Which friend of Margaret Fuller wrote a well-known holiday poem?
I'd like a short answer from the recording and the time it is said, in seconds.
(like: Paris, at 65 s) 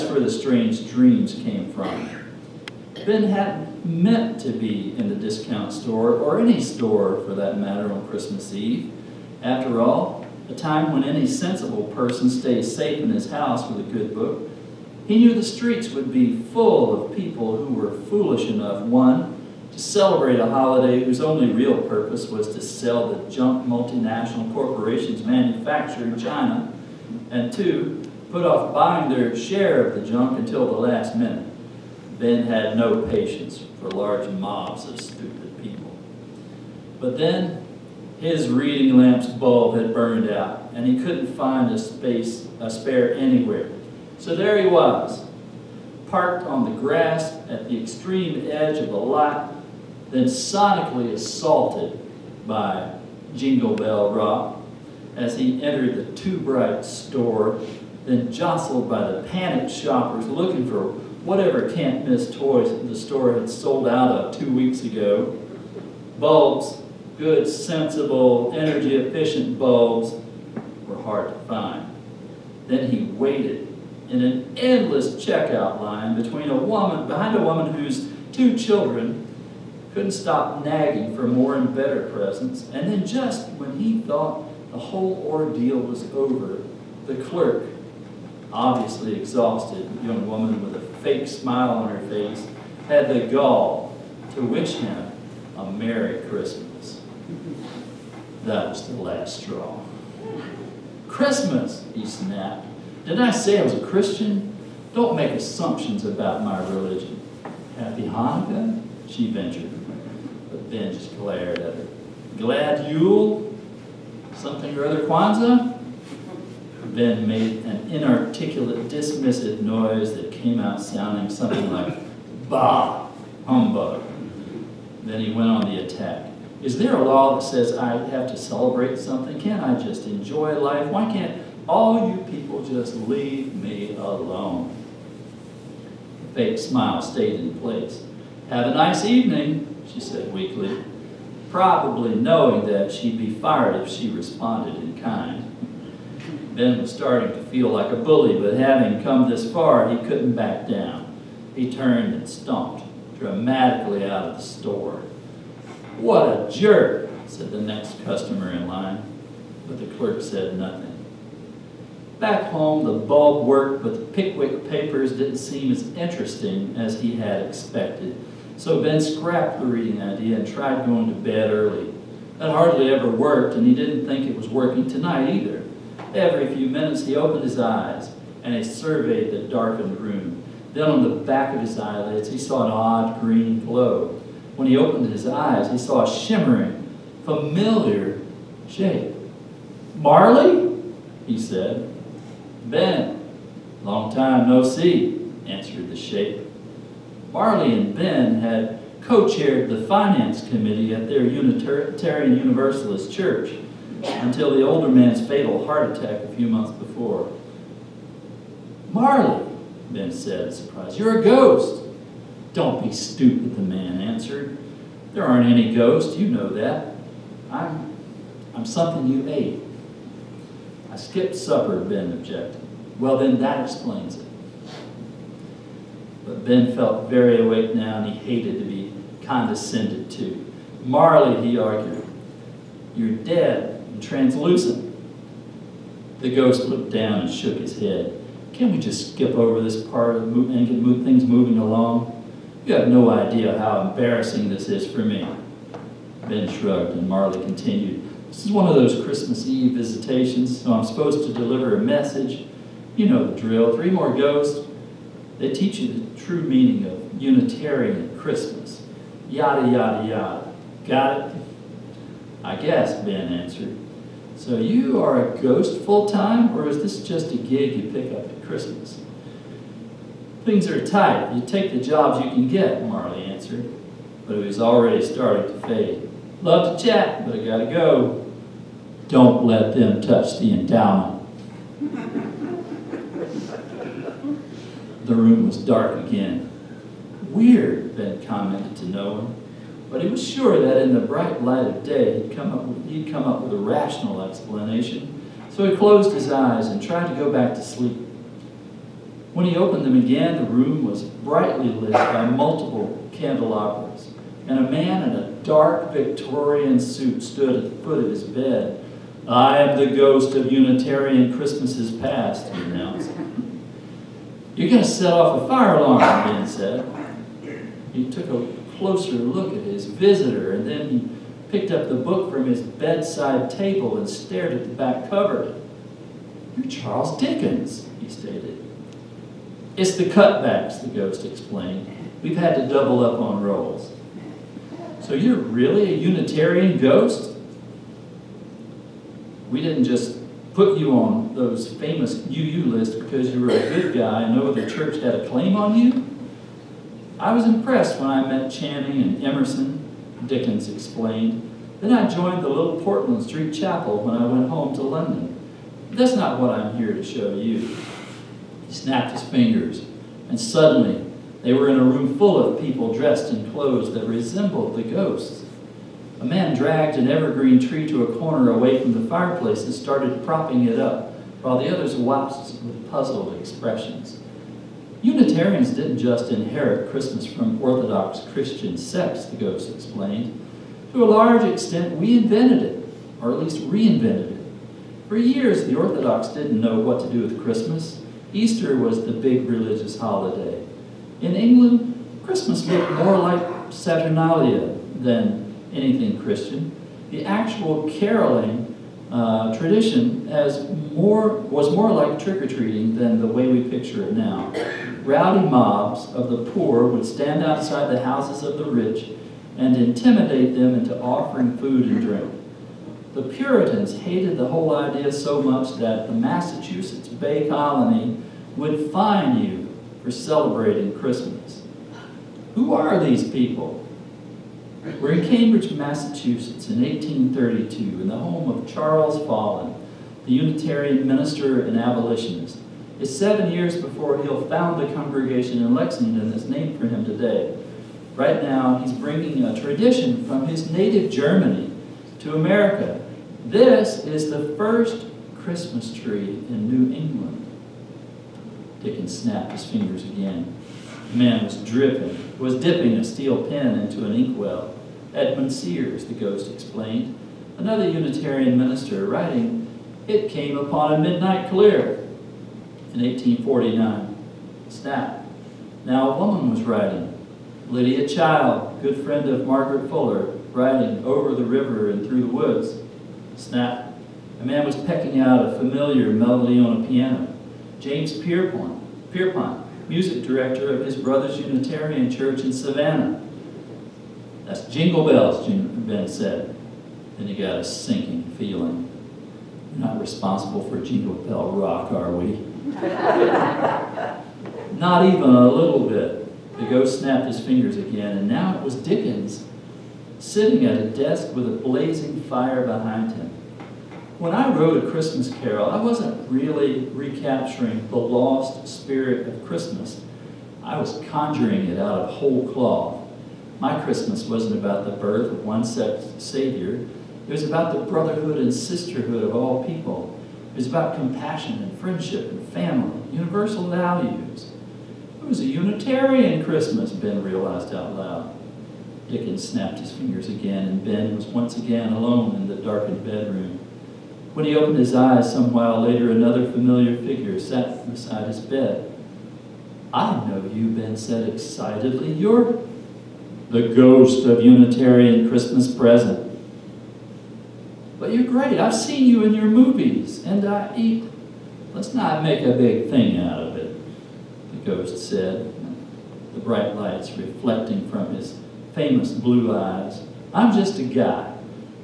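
Lydia Child, at 467 s.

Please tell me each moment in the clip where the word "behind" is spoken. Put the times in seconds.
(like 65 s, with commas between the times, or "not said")
77 s, 502 s.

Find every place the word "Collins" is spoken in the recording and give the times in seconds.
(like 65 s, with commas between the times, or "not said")
not said.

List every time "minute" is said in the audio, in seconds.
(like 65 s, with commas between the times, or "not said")
31 s, 176 s.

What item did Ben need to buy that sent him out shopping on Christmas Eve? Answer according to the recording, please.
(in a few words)
Reading lamp bulb.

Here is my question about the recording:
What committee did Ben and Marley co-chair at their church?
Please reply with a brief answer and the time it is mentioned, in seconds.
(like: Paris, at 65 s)
Finance committee, at 199 s.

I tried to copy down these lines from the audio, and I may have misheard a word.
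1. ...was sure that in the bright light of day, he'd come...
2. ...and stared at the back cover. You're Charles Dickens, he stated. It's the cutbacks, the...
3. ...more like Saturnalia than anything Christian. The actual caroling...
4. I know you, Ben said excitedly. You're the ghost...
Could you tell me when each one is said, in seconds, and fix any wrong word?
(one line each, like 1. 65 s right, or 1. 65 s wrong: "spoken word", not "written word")
1. 290 s right
2. 323 s right
3. 392 s right
4. 539 s right.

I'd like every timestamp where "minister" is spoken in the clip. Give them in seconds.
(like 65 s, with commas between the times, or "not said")
431 s, 458 s.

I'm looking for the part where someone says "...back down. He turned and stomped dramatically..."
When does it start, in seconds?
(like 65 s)
150 s.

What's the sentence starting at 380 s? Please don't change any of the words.
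To a large extent, we invented it, or at least reinvented it.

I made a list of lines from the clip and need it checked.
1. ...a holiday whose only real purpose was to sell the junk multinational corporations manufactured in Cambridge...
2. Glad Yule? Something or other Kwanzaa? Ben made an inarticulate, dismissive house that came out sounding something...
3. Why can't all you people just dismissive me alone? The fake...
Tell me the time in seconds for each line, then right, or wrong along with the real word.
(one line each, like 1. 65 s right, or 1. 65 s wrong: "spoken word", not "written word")
1. 20 s wrong: "China", not "Cambridge"
2. 112 s wrong: "noise", not "house"
3. 130 s wrong: "leave", not "dismissive".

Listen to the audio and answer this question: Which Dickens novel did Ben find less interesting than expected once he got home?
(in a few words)
The Pickwick Papers.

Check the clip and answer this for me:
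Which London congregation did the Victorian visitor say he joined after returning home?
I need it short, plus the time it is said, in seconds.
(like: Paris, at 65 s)
Portland Street Chapel, at 352 s.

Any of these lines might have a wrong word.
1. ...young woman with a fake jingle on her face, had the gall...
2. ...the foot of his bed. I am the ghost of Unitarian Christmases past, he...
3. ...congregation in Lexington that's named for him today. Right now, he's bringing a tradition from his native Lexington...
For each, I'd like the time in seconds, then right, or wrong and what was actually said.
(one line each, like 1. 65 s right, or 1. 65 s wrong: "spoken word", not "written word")
1. 90 s wrong: "smile", not "jingle"
2. 307 s right
3. 434 s wrong: "Germany", not "Lexington".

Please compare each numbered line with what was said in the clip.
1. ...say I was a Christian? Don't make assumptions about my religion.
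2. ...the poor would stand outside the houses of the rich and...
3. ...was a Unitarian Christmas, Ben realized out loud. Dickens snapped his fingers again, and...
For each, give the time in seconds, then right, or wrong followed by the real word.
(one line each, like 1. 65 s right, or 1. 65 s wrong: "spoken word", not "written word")
1. 103 s right
2. 406 s right
3. 525 s right.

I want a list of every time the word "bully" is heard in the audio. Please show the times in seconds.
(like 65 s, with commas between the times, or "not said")
147 s.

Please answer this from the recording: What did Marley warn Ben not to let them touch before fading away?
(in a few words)
The endowment.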